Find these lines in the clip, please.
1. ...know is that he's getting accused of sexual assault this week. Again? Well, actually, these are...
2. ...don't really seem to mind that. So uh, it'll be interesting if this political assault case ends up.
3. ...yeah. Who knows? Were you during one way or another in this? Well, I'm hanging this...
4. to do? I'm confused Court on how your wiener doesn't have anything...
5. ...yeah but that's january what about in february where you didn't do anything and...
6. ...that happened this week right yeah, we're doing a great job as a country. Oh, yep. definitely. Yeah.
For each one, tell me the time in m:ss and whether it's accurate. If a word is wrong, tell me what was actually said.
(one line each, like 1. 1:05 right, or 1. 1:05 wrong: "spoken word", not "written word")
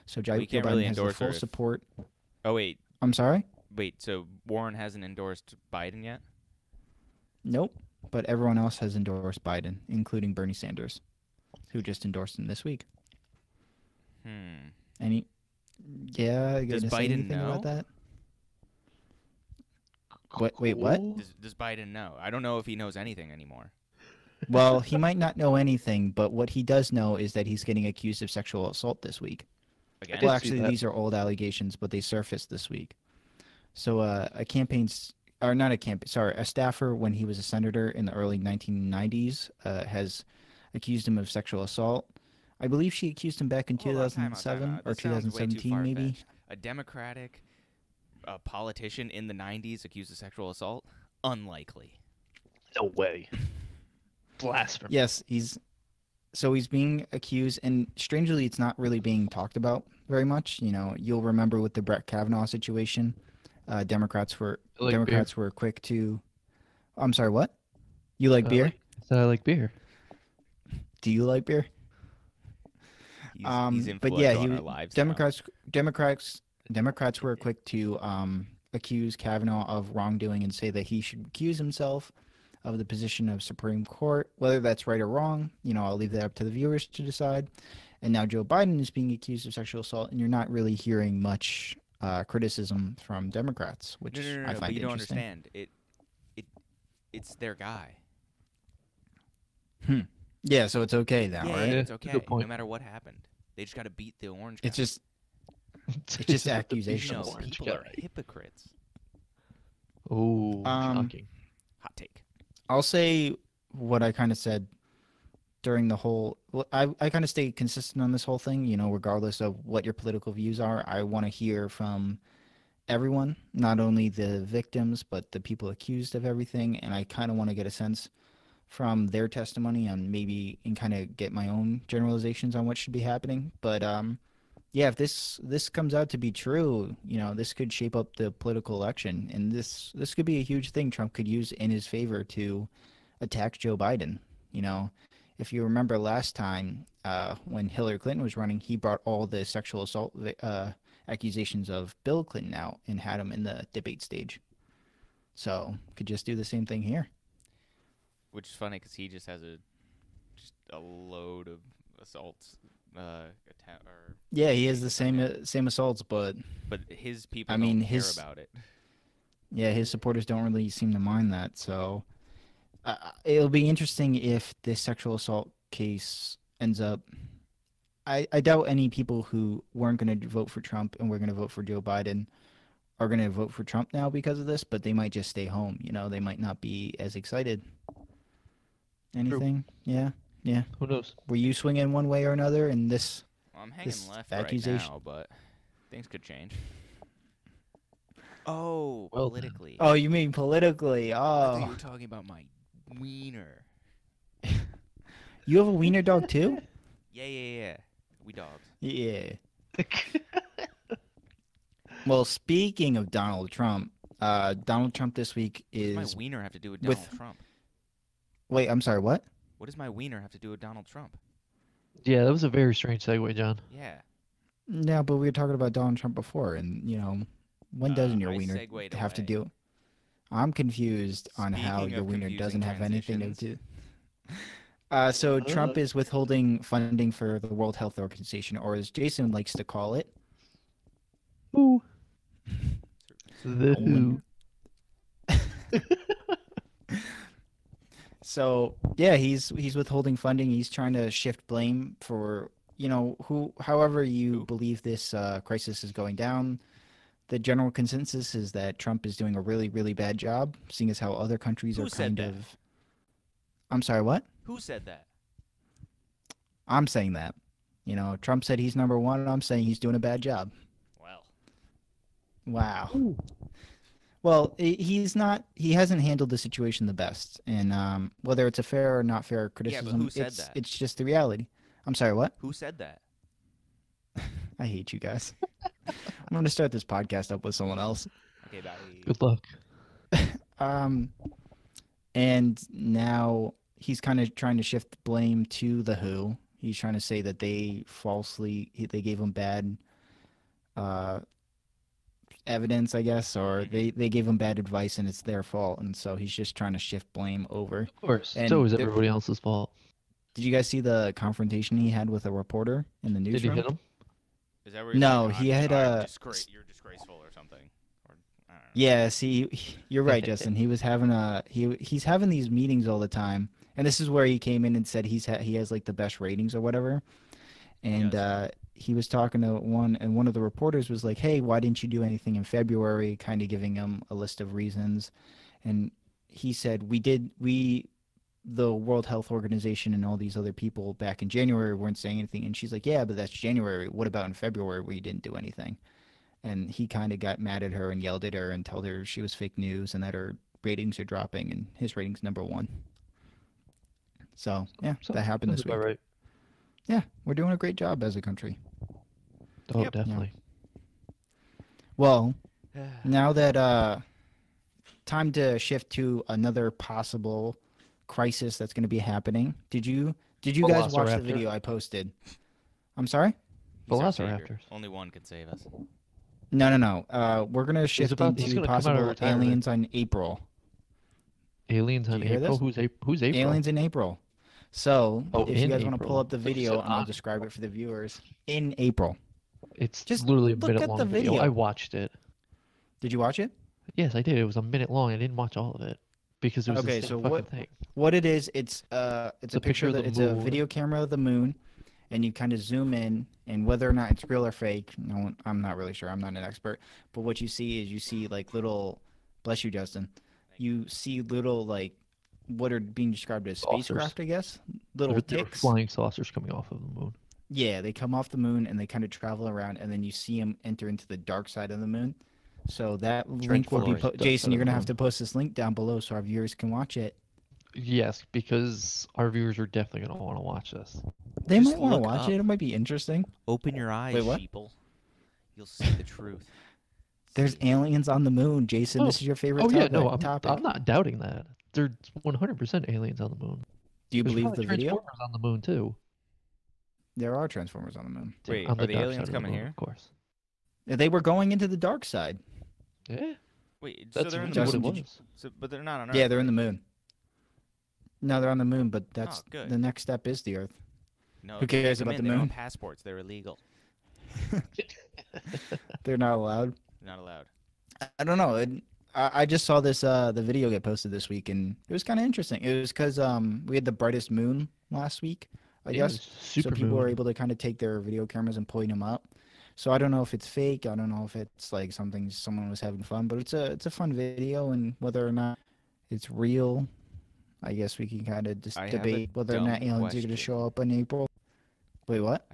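1. 0:26 right
2. 2:50 wrong: "sexual", not "political"
3. 3:10 wrong: "swinging", not "during"
4. 3:48 wrong: "Speaking", not "Court"
5. 5:42 right
6. 5:55 right.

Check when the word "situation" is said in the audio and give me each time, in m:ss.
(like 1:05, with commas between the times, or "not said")
1:02, 4:36.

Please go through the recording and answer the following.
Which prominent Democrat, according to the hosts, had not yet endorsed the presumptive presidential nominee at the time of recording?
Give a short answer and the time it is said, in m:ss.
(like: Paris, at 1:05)
Warren, at 0:04.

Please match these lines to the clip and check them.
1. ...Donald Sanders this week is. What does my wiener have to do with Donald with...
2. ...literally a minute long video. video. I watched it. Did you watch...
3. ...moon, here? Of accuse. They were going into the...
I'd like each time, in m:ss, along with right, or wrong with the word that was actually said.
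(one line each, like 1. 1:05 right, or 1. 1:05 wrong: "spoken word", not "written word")
1. 3:34 wrong: "Trump", not "Sanders"
2. 6:30 right
3. 7:29 wrong: "course", not "accuse".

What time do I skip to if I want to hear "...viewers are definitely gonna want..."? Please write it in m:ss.
7:09.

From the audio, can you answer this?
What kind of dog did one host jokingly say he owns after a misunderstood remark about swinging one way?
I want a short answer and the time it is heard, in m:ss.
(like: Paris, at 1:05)
Wiener dog, at 3:25.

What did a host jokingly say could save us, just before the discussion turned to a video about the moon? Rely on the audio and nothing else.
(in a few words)
Velociraptors.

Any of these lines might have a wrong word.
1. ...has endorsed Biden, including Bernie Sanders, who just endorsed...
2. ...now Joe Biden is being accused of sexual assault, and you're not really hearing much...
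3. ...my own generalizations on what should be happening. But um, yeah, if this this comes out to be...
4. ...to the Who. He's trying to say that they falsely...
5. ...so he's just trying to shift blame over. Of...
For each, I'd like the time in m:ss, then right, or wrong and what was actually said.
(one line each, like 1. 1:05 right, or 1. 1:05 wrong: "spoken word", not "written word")
1. 0:08 right
2. 1:28 right
3. 2:11 right
4. 4:55 right
5. 5:05 right.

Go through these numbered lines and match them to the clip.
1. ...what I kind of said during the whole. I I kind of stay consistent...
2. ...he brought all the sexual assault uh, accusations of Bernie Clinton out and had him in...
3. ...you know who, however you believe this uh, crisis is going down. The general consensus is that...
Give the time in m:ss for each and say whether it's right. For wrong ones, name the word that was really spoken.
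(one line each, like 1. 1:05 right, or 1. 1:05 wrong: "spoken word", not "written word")
1. 1:53 right
2. 2:28 wrong: "Bill", not "Bernie"
3. 4:12 right.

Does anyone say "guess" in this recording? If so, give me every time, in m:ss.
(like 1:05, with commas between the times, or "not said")
5:03, 6:54, 7:55, 8:07.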